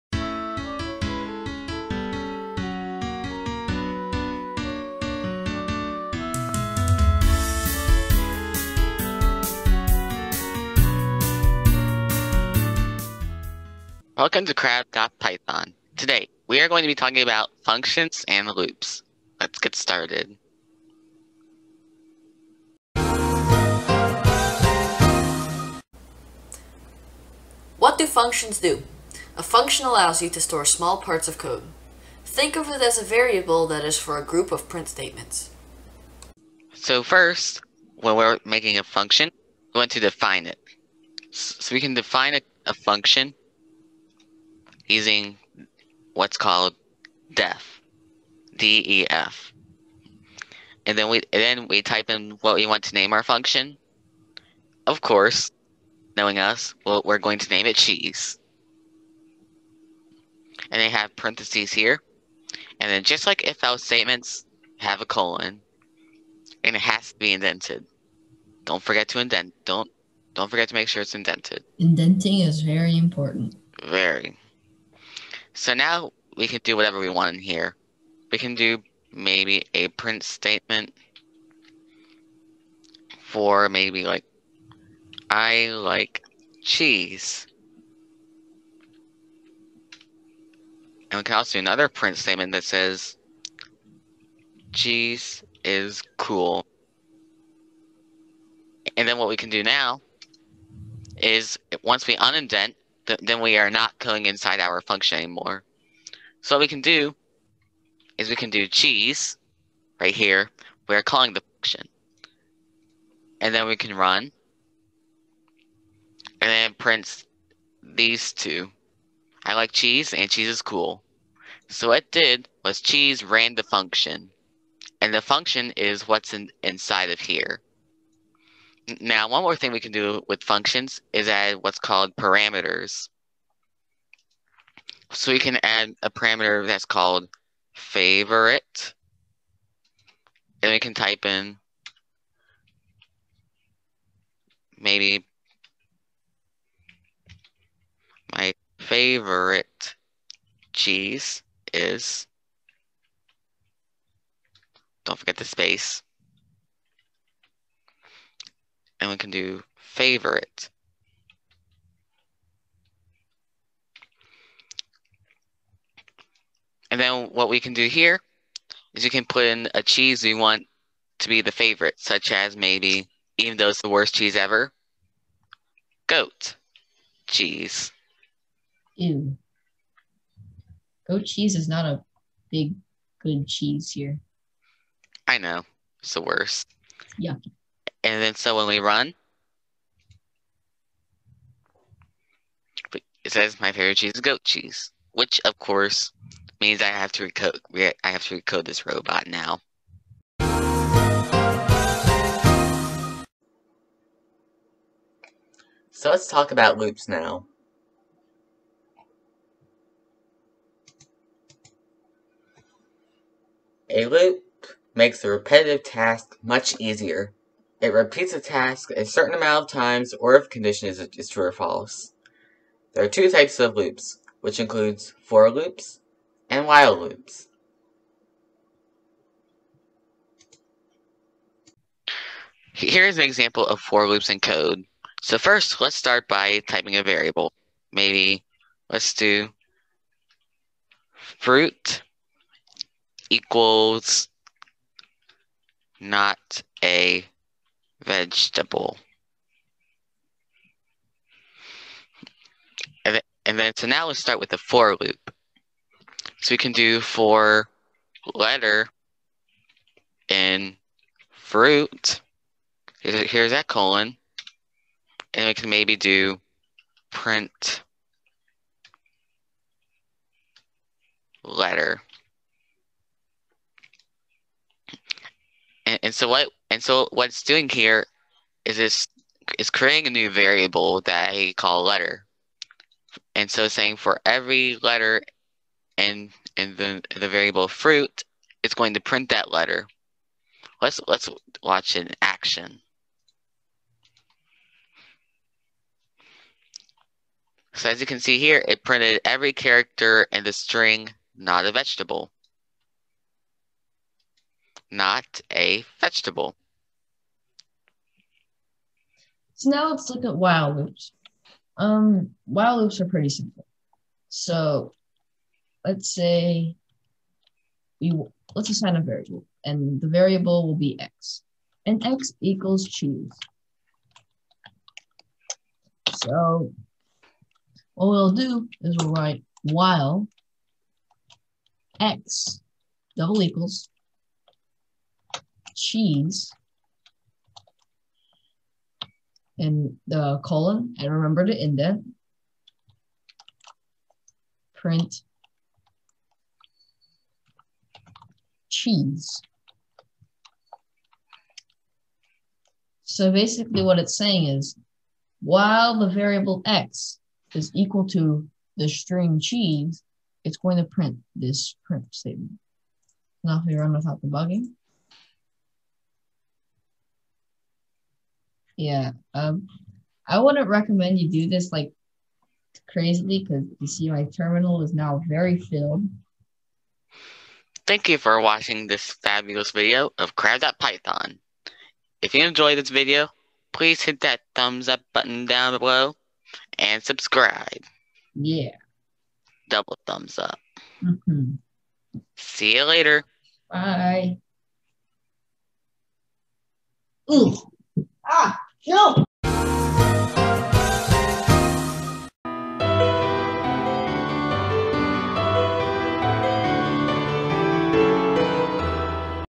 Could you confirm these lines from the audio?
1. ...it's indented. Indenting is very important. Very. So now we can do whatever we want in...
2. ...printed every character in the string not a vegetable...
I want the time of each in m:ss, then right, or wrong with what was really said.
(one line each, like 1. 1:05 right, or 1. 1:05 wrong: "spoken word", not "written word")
1. 1:11 right
2. 4:58 right.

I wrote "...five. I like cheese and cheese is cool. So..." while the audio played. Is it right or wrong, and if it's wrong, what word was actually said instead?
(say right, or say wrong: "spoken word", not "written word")
wrong: "two", not "five".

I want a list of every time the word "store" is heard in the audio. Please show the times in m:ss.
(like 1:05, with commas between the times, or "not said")
0:30.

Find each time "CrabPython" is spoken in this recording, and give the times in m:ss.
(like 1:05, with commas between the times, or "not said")
0:14, 6:20.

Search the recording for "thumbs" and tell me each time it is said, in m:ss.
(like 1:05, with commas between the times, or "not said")
6:24, 6:30.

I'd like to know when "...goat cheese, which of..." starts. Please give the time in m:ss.
3:14.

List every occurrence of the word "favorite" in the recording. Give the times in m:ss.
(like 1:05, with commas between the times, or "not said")
2:17, 2:28, 2:39, 2:51, 3:13.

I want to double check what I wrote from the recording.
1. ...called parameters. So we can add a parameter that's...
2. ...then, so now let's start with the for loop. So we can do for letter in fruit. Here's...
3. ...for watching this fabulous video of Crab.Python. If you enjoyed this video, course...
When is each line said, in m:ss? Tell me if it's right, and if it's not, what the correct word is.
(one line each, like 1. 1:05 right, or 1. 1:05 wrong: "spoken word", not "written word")
1. 2:11 right
2. 4:13 right
3. 6:18 wrong: "please", not "course".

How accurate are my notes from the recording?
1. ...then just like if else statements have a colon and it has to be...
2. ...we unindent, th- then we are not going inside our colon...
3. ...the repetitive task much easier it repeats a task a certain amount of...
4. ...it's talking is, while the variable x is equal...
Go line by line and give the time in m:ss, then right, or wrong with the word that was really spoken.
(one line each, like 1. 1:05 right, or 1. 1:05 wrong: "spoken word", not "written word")
1. 1:02 right
2. 1:42 wrong: "function", not "colon"
3. 3:35 right
4. 5:53 wrong: "saying", not "talking".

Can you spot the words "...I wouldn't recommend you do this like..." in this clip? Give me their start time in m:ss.
6:10.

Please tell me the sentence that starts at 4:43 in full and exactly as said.
And so saying for every letter in in the the variable fruit, it's going to print that letter.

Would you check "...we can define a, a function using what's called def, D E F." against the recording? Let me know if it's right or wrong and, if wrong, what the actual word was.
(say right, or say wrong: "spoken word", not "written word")
right.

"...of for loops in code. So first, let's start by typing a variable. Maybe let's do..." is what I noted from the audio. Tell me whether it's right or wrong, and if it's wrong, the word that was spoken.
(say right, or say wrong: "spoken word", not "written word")
right.